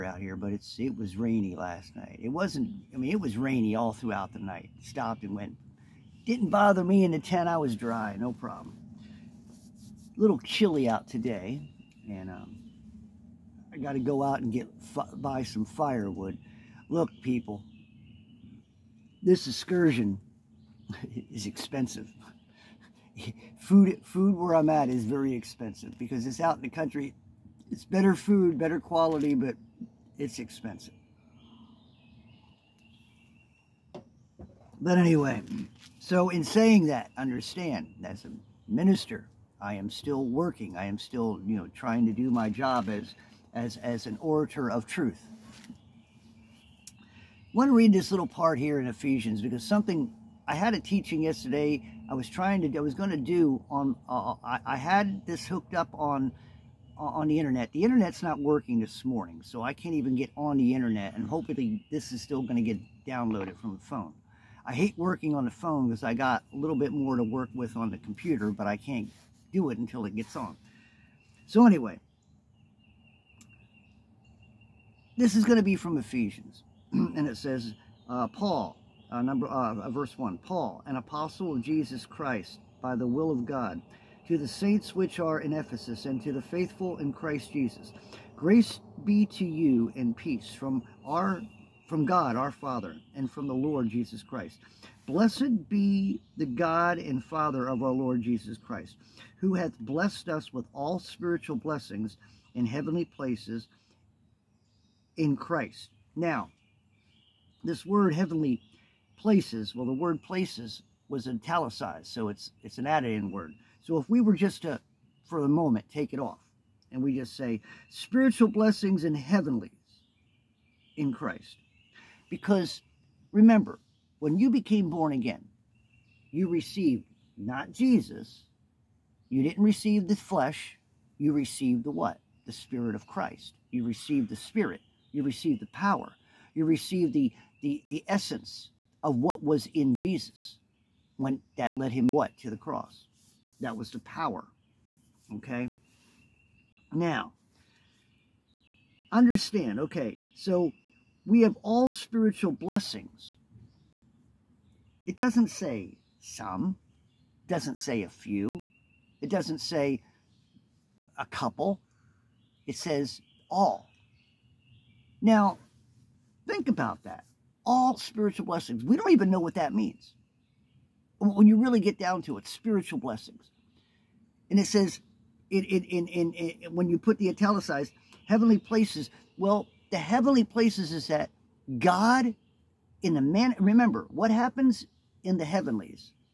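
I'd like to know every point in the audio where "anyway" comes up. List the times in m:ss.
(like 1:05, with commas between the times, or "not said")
0:34, 1:11.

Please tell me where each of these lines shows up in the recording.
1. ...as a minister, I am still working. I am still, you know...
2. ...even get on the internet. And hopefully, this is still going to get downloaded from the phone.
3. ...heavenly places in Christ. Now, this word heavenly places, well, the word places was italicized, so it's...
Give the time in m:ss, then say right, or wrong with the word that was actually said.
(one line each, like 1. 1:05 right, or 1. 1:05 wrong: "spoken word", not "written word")
1. 0:38 right
2. 0:59 right
3. 1:42 right.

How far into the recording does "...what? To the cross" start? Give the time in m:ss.
2:22.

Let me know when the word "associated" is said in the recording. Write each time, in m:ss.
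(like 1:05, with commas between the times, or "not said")
not said.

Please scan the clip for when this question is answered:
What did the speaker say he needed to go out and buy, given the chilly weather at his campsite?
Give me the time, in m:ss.
0:15.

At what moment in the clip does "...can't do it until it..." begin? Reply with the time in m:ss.
1:08.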